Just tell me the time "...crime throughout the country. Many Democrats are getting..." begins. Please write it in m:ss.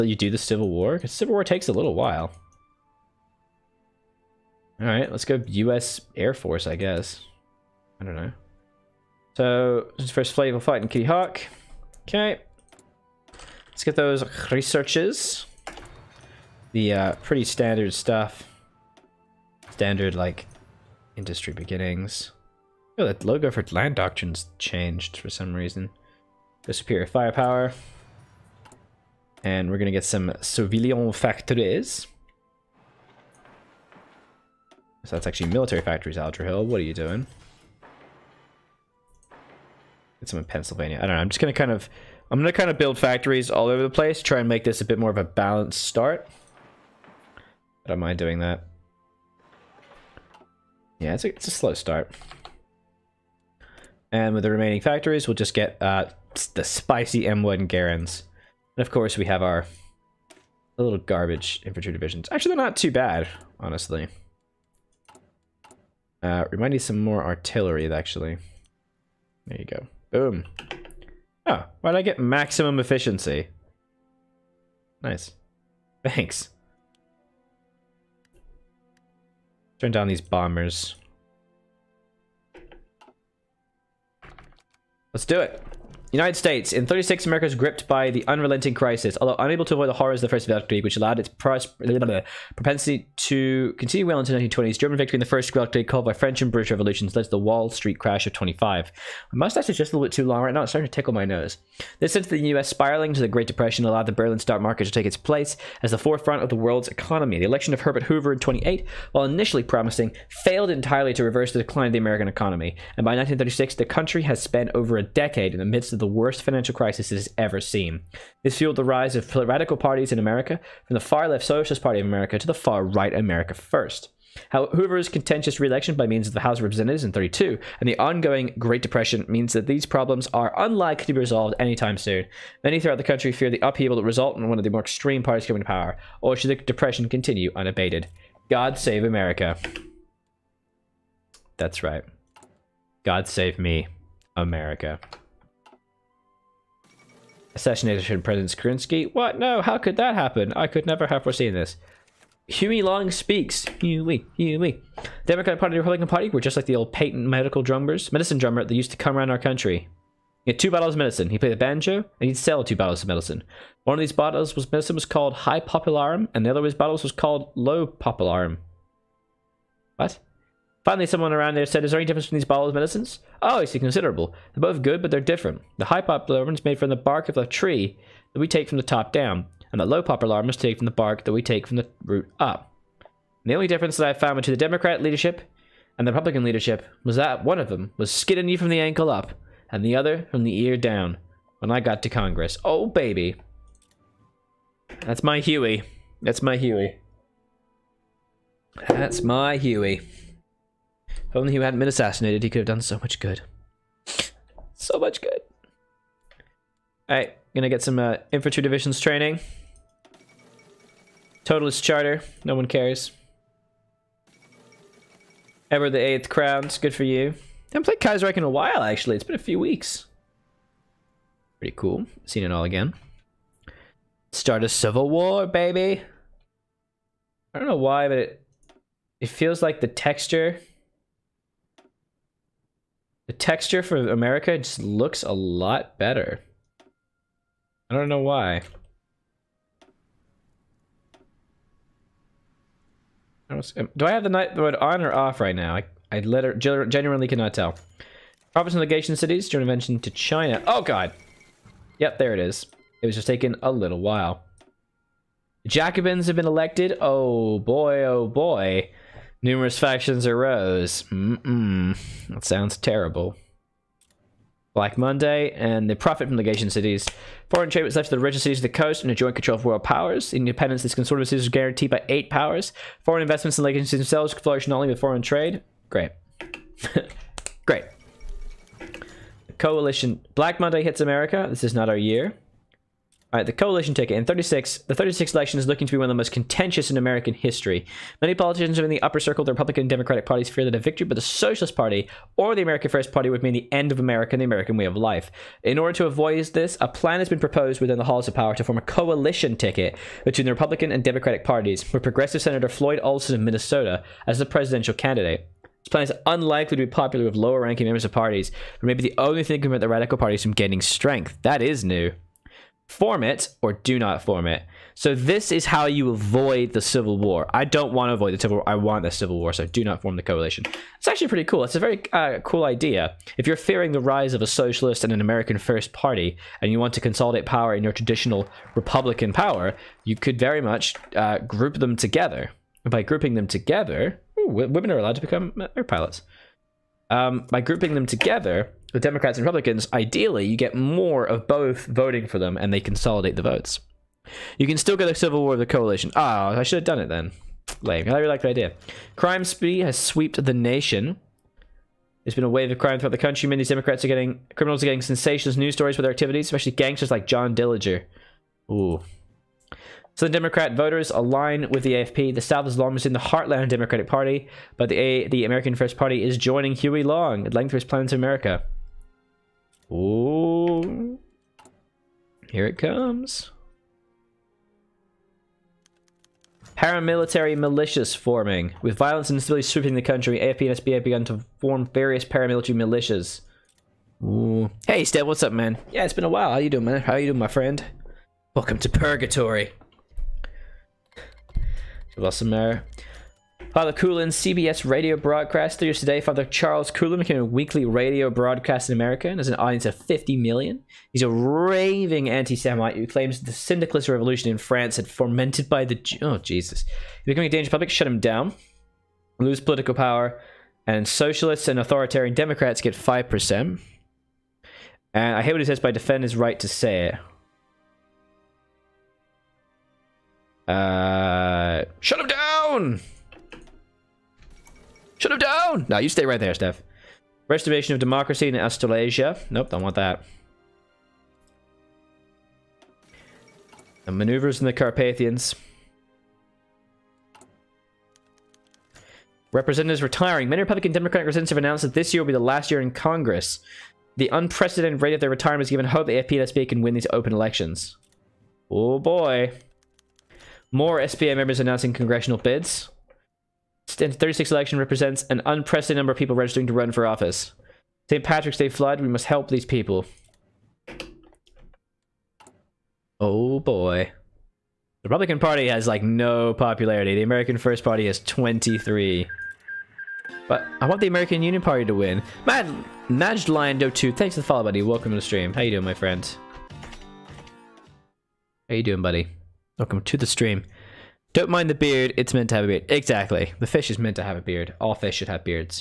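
5:52.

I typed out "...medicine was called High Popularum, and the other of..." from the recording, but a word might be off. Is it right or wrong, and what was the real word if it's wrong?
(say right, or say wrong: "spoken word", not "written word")
right.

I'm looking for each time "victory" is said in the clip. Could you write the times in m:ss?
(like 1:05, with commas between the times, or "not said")
1:34, 4:50.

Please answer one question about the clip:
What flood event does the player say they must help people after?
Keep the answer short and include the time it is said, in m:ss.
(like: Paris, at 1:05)
St. Patrick's Day flood, at 7:38.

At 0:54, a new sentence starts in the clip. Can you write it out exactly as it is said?
And with the remaining factories, we'll just get uh, the spicy M1 Garands.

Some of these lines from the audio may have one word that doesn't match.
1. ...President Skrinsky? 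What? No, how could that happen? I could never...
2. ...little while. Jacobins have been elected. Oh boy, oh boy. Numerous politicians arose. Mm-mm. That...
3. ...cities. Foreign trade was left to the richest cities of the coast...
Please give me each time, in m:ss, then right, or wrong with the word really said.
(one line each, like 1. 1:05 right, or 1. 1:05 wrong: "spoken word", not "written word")
1. 2:28 right
2. 4:13 wrong: "factions", not "politicians"
3. 4:26 right.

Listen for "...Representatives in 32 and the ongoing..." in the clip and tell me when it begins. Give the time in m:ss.
2:06.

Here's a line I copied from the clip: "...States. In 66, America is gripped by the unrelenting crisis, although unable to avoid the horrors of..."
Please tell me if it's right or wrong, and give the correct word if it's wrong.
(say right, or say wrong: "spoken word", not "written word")
wrong: "36", not "66".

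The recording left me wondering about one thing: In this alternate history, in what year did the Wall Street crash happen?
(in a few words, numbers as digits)
1925.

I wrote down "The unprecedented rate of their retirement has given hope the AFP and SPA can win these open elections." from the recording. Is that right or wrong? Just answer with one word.
right.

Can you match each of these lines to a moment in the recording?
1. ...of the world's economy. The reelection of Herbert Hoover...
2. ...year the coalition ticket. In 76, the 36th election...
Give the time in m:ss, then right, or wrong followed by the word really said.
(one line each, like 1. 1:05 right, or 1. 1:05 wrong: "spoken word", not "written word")
1. 1:46 wrong: "election", not "reelection"
2. 4:41 wrong: "36", not "76".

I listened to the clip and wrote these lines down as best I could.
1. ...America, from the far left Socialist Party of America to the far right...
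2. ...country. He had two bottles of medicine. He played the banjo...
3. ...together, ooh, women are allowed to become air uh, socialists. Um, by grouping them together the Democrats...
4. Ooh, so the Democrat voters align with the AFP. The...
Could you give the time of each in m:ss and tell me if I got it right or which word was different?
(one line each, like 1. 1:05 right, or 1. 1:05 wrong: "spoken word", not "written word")
1. 2:00 right
2. 2:39 right
3. 5:33 wrong: "pilots", not "socialists"
4. 5:58 right.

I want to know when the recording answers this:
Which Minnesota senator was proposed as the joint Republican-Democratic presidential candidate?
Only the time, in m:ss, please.
5:02.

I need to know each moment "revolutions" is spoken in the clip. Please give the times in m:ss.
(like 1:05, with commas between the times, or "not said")
1:36, 6:44.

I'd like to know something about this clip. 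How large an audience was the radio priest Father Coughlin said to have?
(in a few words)
50 million.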